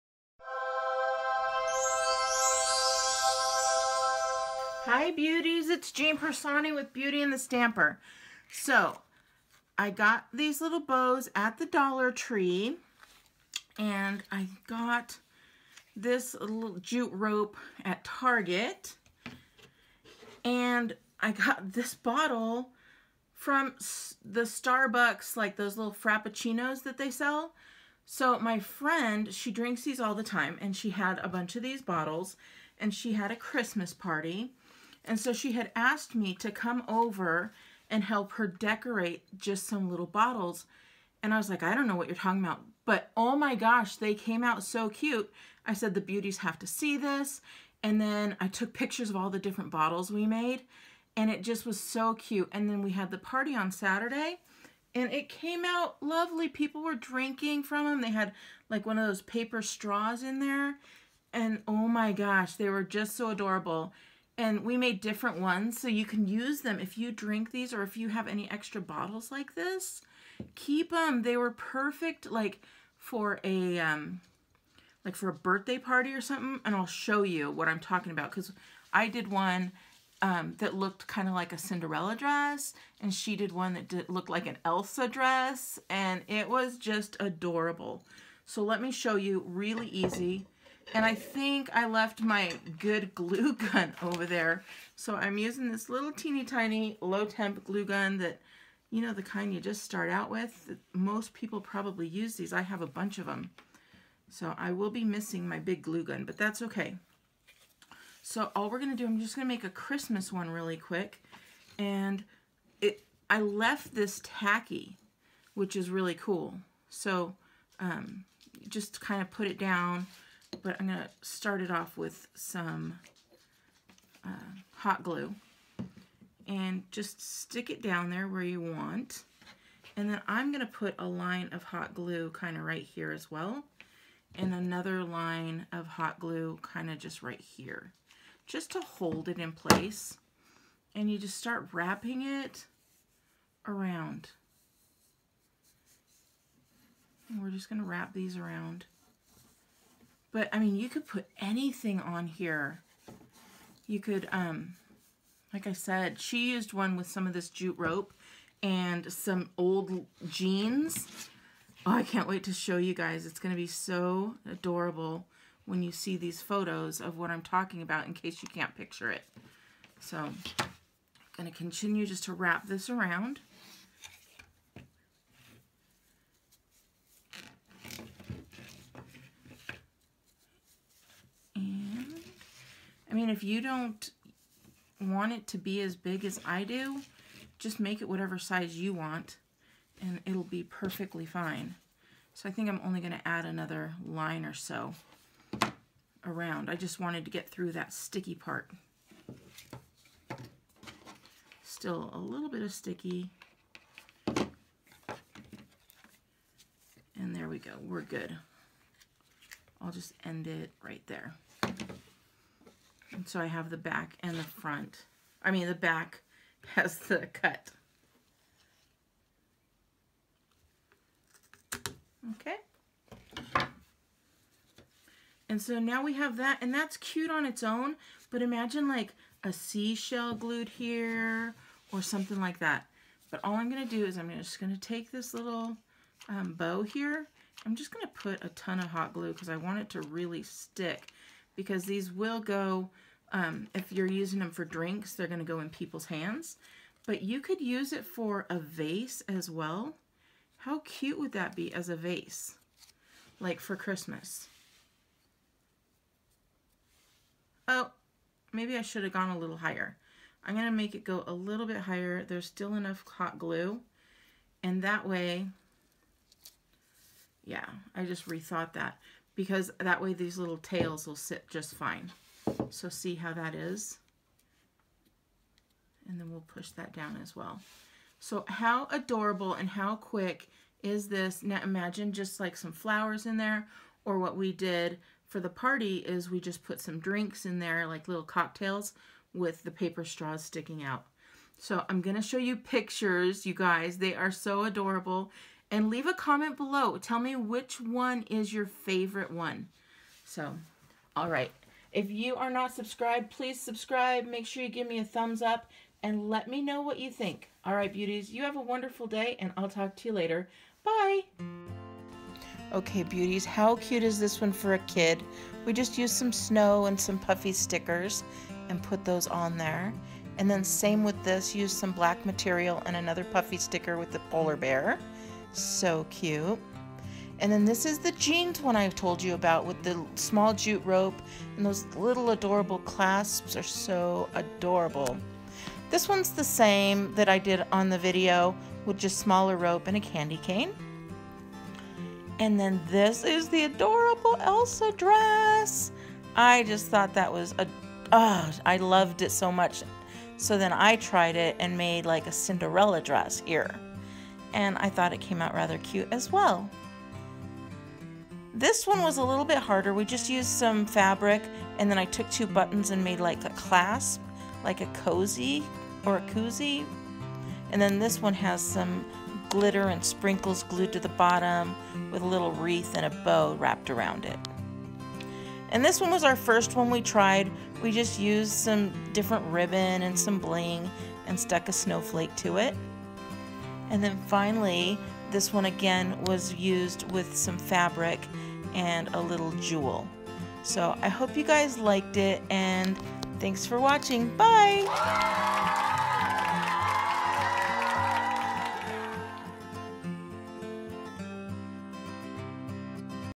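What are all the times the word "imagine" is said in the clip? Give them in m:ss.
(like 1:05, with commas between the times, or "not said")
3:48, 4:41.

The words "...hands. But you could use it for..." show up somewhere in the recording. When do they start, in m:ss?
4:06.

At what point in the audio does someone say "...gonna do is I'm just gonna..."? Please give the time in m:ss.
3:53.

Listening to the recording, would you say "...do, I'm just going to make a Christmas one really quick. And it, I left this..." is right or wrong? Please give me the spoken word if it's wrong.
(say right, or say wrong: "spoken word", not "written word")
right.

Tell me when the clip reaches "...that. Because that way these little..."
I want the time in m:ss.
4:28.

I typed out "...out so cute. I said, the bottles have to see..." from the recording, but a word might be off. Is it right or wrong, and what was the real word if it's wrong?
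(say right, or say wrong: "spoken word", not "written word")
wrong: "beauties", not "bottles".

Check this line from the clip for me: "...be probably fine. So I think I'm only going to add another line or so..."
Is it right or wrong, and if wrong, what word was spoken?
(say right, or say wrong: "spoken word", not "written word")
wrong: "perfectly", not "probably".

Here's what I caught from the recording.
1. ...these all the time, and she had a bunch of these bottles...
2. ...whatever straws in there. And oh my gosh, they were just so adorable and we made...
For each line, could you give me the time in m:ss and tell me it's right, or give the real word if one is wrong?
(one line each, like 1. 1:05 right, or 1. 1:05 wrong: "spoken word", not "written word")
1. 0:29 right
2. 0:59 wrong: "paper", not "whatever".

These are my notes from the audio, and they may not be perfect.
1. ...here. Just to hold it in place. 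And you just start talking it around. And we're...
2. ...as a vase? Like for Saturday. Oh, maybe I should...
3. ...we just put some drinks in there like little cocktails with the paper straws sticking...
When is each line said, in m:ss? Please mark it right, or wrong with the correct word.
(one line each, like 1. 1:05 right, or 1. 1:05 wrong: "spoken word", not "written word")
1. 2:17 wrong: "wrapping", not "talking"
2. 4:11 wrong: "Christmas", not "Saturday"
3. 4:46 right.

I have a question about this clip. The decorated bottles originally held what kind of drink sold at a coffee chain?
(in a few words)
frappuccinos.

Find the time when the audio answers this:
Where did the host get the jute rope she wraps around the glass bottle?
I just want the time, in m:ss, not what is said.
0:18.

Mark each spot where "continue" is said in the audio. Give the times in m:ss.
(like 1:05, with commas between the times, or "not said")
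2:51.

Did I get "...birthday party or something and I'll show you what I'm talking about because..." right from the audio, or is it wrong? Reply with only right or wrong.
right.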